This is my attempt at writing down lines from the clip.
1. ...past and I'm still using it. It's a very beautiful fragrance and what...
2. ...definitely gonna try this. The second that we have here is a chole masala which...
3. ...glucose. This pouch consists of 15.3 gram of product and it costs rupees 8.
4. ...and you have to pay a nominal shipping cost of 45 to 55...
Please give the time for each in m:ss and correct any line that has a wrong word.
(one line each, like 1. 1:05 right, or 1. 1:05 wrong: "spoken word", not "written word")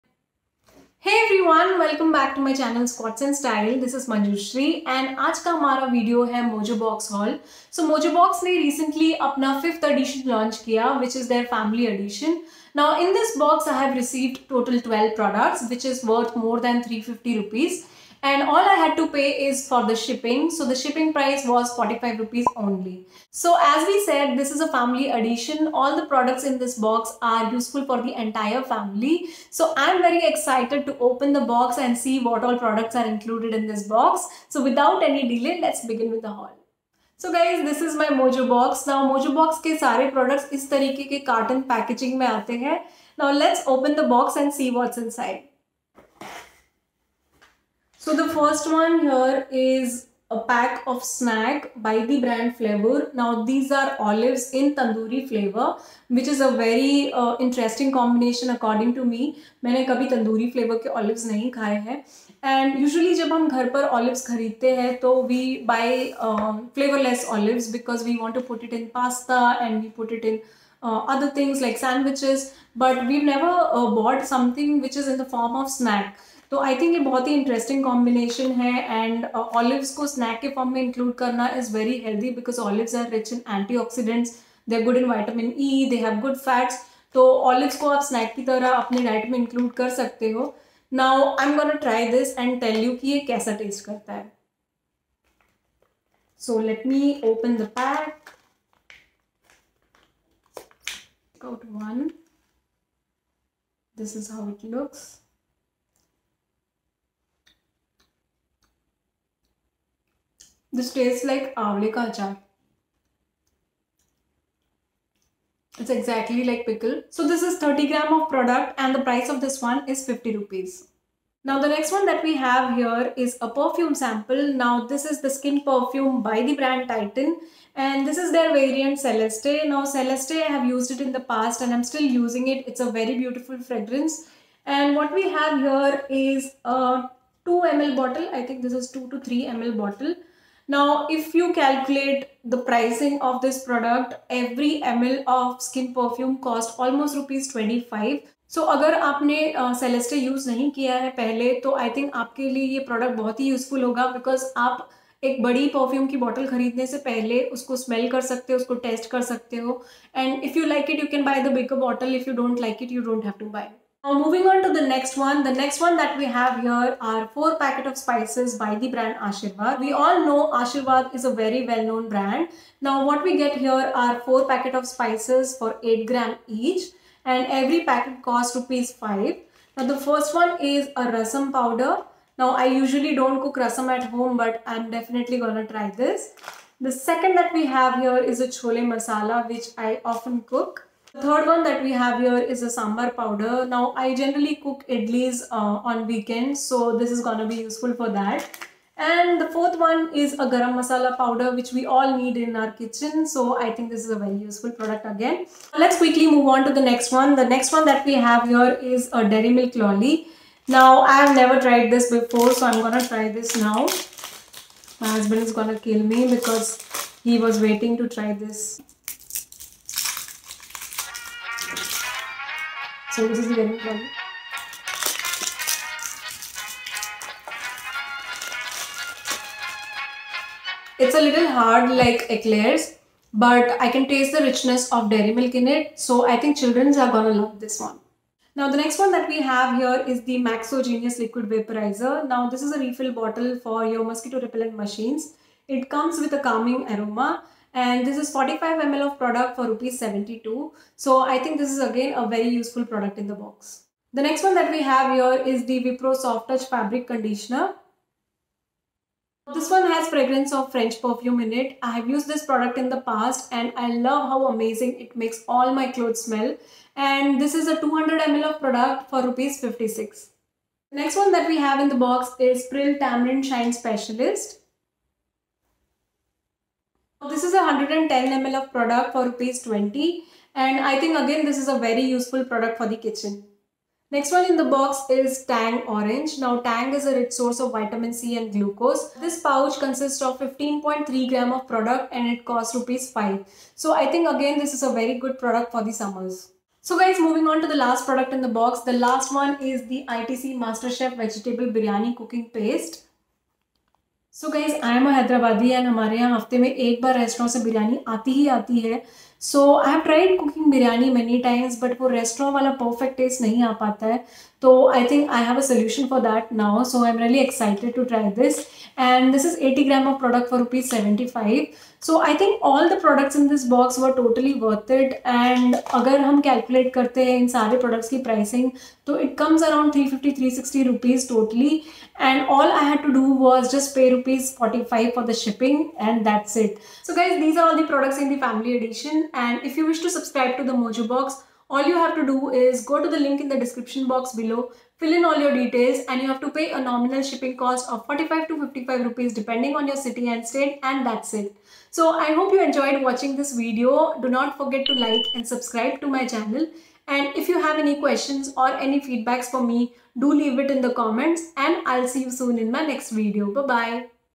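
1. 2:11 right
2. 3:04 right
3. 4:48 wrong: "5", not "8"
4. 5:46 right.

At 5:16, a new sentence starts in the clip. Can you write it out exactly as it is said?
So I'm really excited to try this.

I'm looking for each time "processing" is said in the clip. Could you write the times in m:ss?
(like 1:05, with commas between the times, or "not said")
not said.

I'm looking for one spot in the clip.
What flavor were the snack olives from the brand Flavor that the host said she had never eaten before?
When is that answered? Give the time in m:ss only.
0:54.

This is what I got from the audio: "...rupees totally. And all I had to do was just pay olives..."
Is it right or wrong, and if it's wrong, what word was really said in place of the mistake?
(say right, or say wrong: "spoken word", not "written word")
wrong: "rupees", not "olives".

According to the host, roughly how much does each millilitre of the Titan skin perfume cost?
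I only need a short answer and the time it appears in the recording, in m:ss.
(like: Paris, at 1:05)
25 rupees, at 2:27.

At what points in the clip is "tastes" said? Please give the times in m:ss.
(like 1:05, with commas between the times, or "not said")
1:50, 3:54.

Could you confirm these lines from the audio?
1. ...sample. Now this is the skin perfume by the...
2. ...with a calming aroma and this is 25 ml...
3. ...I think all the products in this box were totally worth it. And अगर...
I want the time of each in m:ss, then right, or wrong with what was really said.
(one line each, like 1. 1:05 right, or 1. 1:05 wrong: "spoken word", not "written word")
1. 2:03 right
2. 4:06 wrong: "45", not "25"
3. 5:22 right.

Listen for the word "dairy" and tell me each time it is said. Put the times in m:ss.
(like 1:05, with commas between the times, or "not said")
3:29, 3:55.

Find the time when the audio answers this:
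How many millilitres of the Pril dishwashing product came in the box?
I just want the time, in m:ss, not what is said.
4:37.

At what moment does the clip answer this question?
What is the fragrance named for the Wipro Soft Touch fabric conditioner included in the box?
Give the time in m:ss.
4:20.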